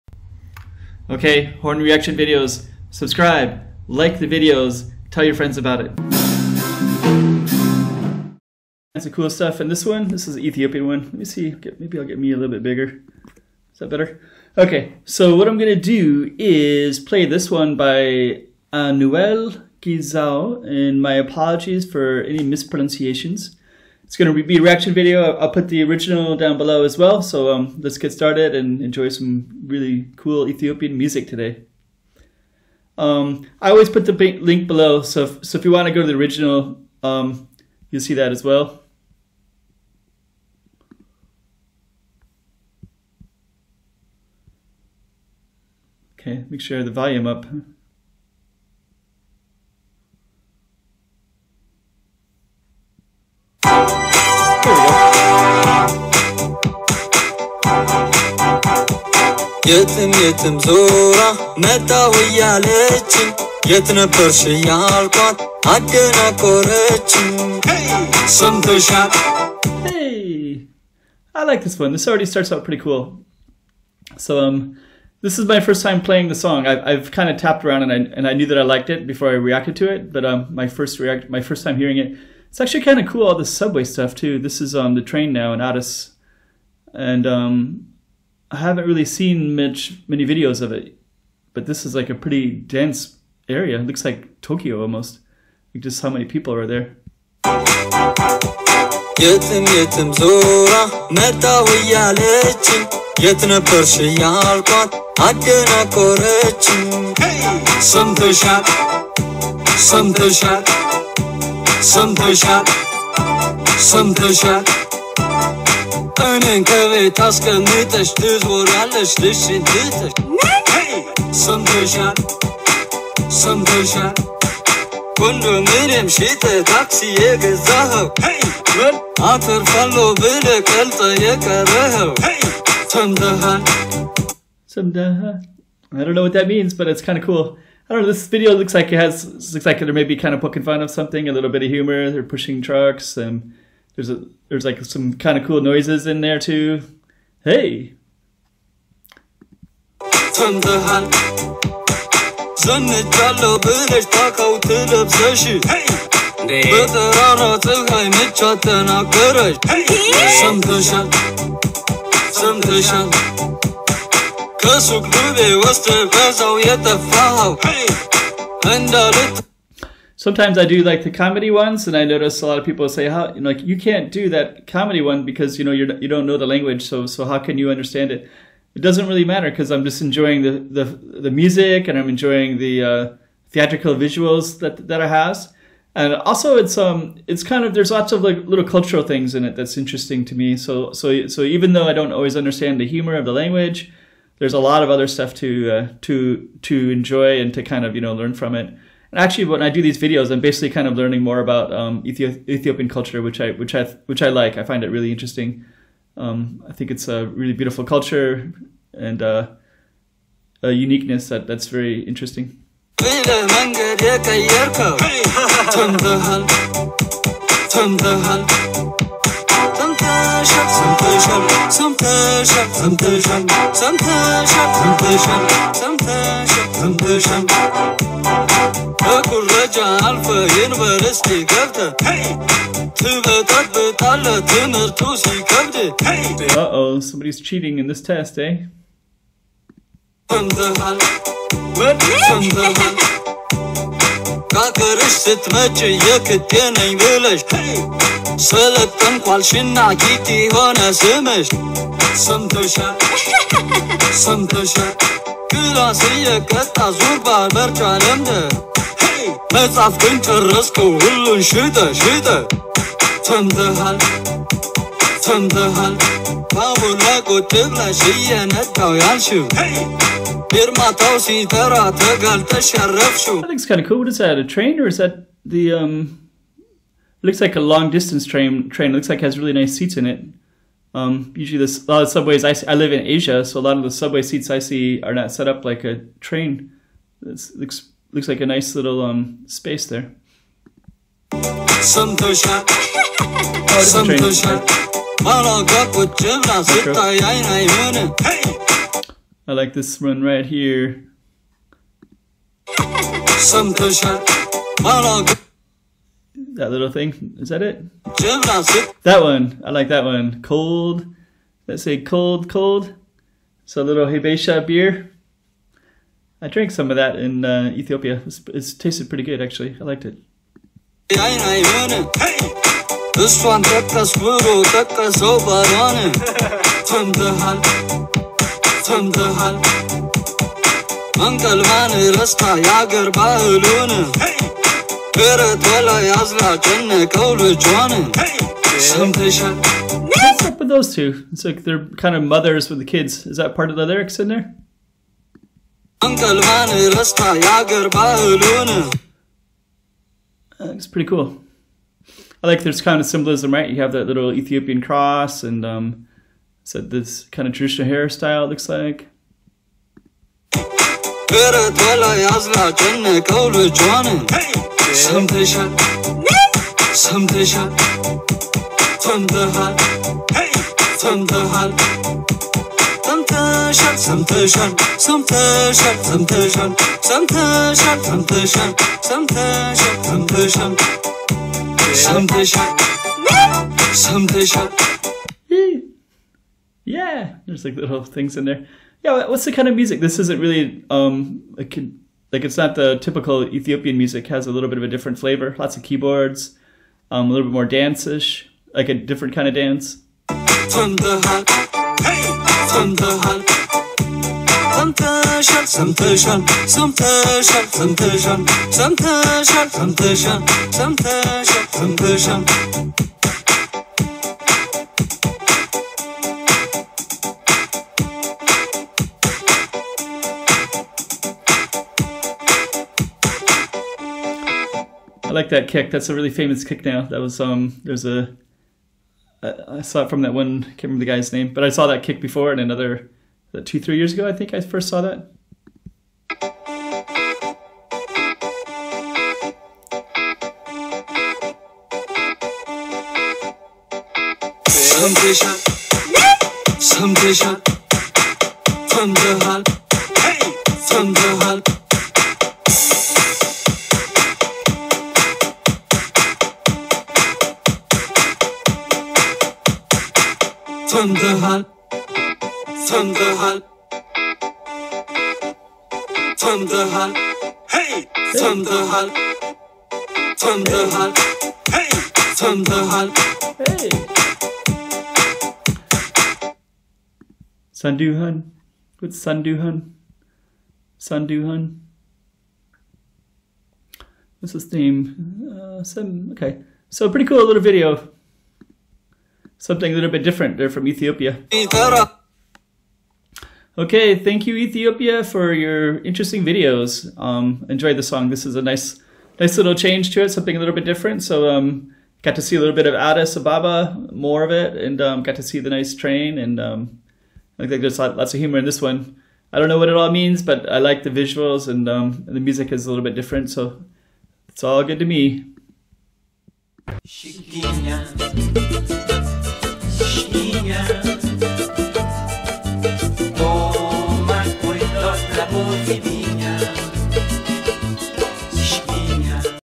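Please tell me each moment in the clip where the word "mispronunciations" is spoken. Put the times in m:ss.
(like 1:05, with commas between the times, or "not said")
0:22.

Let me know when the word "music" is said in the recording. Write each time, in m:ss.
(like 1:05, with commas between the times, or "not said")
0:30, 3:01, 6:29, 6:33, 8:32.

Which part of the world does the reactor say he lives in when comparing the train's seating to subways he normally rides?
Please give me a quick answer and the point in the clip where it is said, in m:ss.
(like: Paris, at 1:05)
Asia, at 4:43.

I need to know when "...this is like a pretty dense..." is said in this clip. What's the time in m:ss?
1:31.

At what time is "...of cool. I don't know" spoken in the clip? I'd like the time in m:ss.
2:17.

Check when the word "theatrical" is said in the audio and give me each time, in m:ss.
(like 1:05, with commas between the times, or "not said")
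3:03.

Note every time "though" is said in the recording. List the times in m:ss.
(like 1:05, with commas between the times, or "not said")
3:11.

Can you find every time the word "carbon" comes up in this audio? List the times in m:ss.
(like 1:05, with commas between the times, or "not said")
not said.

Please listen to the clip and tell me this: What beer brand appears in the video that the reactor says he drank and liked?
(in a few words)
Habesha.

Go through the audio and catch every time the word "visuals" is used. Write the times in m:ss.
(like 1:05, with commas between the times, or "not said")
3:03, 8:31.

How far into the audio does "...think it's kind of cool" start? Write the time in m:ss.
4:33.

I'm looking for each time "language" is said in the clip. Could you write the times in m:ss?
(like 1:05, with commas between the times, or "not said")
2:56, 3:13.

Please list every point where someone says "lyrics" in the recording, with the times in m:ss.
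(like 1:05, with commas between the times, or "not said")
5:43.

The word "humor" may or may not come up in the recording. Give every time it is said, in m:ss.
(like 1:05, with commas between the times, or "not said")
2:21, 3:12, 8:28.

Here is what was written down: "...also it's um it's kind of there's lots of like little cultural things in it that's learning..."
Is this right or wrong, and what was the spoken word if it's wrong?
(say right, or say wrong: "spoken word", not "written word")
wrong: "interesting", not "learning".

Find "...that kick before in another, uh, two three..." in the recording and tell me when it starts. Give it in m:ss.
7:11.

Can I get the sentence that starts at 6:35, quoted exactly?
Lots of keyboards, um, a little bit more dance-ish.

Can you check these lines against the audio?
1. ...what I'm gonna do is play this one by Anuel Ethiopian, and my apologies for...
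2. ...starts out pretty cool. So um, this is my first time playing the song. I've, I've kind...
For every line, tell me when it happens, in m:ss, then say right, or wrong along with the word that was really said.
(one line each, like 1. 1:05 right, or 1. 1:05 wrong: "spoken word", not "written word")
1. 0:15 wrong: "Gizaw", not "Ethiopian"
2. 1:12 right.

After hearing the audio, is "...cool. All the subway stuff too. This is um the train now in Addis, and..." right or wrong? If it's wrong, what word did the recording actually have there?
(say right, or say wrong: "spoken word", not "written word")
right.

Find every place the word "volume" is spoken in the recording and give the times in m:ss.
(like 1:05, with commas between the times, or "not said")
0:46.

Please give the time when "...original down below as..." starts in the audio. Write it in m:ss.
0:25.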